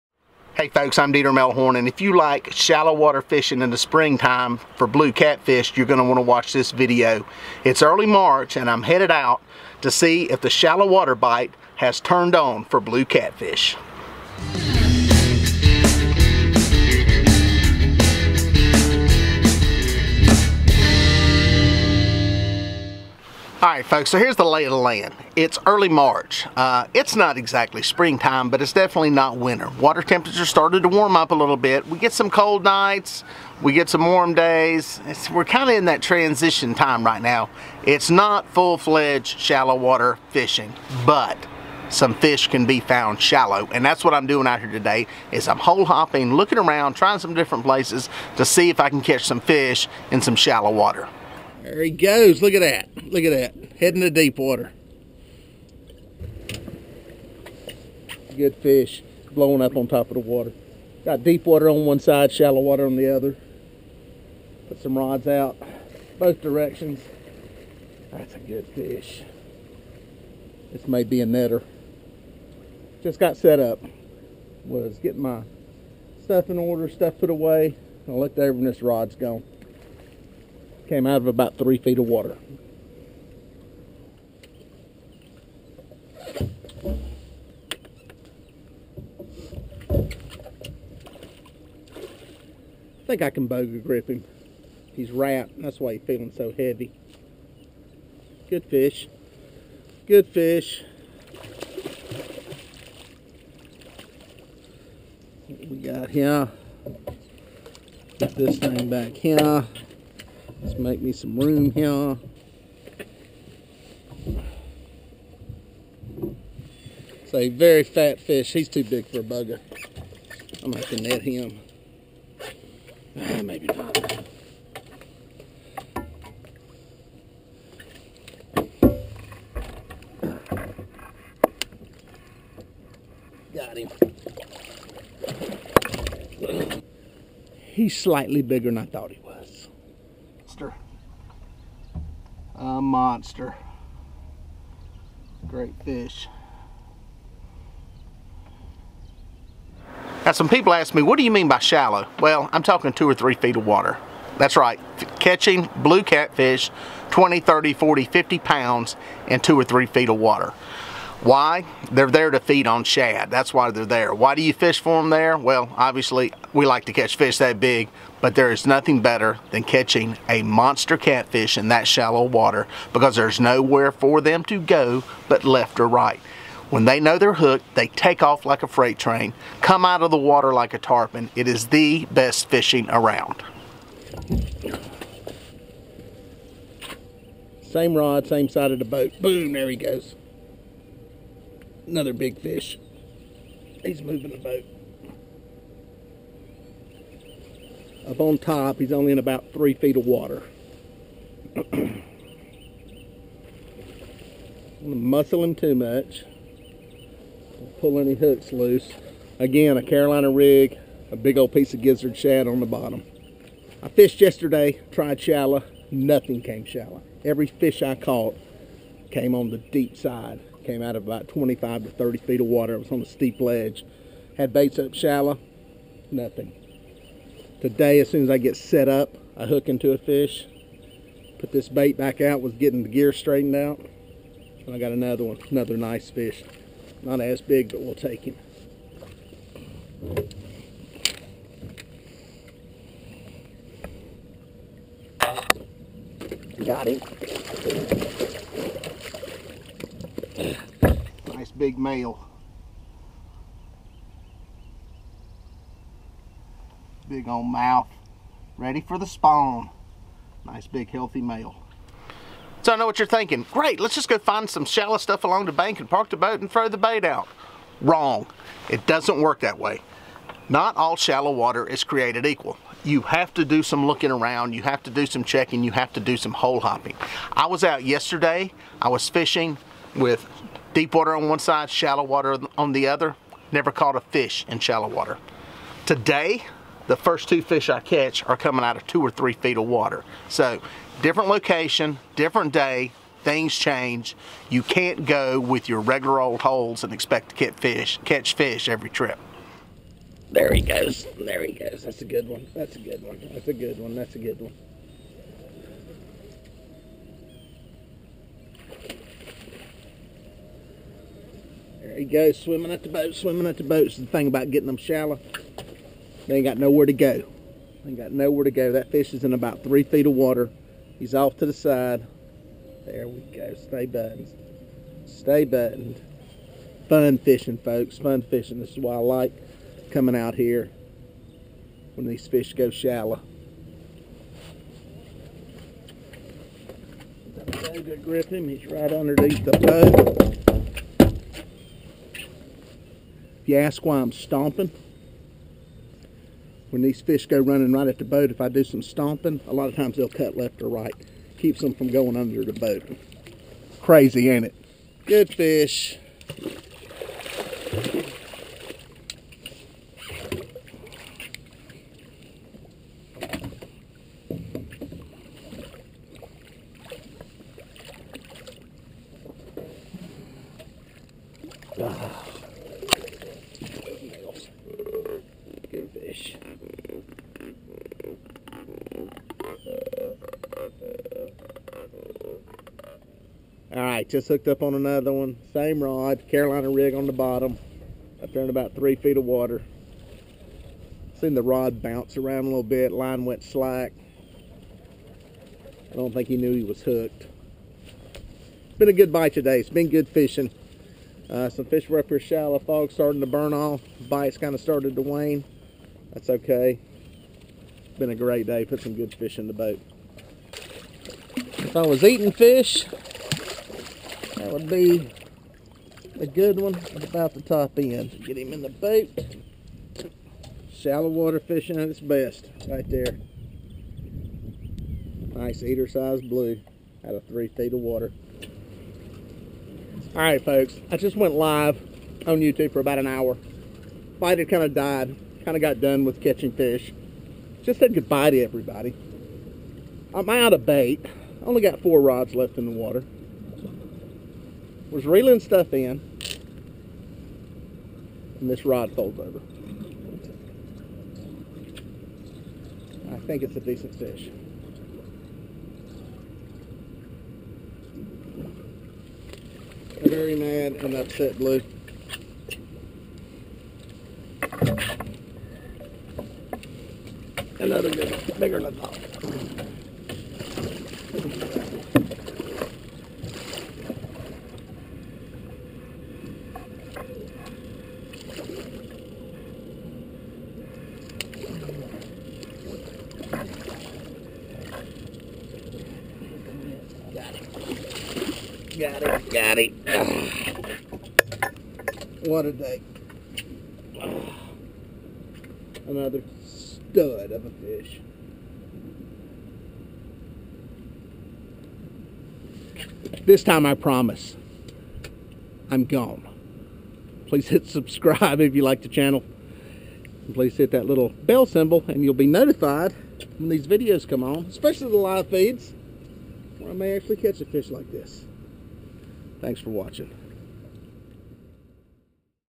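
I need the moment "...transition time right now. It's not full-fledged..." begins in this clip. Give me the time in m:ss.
0:36.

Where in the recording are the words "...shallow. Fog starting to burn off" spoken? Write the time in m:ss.
6:42.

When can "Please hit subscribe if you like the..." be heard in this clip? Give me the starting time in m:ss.
8:27.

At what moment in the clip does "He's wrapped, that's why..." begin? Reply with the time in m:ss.
1:34.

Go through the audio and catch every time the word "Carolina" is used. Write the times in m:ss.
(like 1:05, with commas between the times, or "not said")
3:29, 6:26.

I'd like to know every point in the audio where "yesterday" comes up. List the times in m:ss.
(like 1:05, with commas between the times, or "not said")
3:34, 4:37.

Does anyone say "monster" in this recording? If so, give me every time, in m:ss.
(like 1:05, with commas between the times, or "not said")
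2:22, 2:50.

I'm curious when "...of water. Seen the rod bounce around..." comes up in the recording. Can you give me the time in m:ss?
6:29.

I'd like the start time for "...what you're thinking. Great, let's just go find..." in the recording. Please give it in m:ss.
4:22.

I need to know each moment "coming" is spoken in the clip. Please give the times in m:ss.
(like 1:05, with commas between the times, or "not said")
4:48, 5:29.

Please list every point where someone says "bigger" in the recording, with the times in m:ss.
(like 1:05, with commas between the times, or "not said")
2:18, 7:48.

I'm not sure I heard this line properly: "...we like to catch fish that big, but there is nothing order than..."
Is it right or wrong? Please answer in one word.
wrong.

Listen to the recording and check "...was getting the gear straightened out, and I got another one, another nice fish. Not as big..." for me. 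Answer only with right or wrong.
right.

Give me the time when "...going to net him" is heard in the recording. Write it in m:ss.
2:00.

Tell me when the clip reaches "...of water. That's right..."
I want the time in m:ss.
2:33.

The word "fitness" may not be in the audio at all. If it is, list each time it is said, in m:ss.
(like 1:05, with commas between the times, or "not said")
not said.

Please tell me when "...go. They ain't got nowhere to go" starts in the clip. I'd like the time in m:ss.
5:16.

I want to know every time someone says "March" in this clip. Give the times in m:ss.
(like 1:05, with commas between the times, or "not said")
0:08, 0:25.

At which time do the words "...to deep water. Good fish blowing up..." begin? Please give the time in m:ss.
0:54.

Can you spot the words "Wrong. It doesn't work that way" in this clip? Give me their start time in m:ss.
4:27.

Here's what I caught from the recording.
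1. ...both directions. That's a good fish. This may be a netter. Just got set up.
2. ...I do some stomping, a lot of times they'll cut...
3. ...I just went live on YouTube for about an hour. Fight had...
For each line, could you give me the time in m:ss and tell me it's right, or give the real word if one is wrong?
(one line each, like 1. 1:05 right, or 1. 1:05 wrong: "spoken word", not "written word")
1. 1:06 right
2. 5:48 right
3. 7:10 right.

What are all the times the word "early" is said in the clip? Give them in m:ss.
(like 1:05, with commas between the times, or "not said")
0:07, 0:25.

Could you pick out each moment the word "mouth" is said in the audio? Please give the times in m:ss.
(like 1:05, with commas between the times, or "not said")
4:17.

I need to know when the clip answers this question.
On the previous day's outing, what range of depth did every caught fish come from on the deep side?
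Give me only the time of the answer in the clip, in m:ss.
3:41.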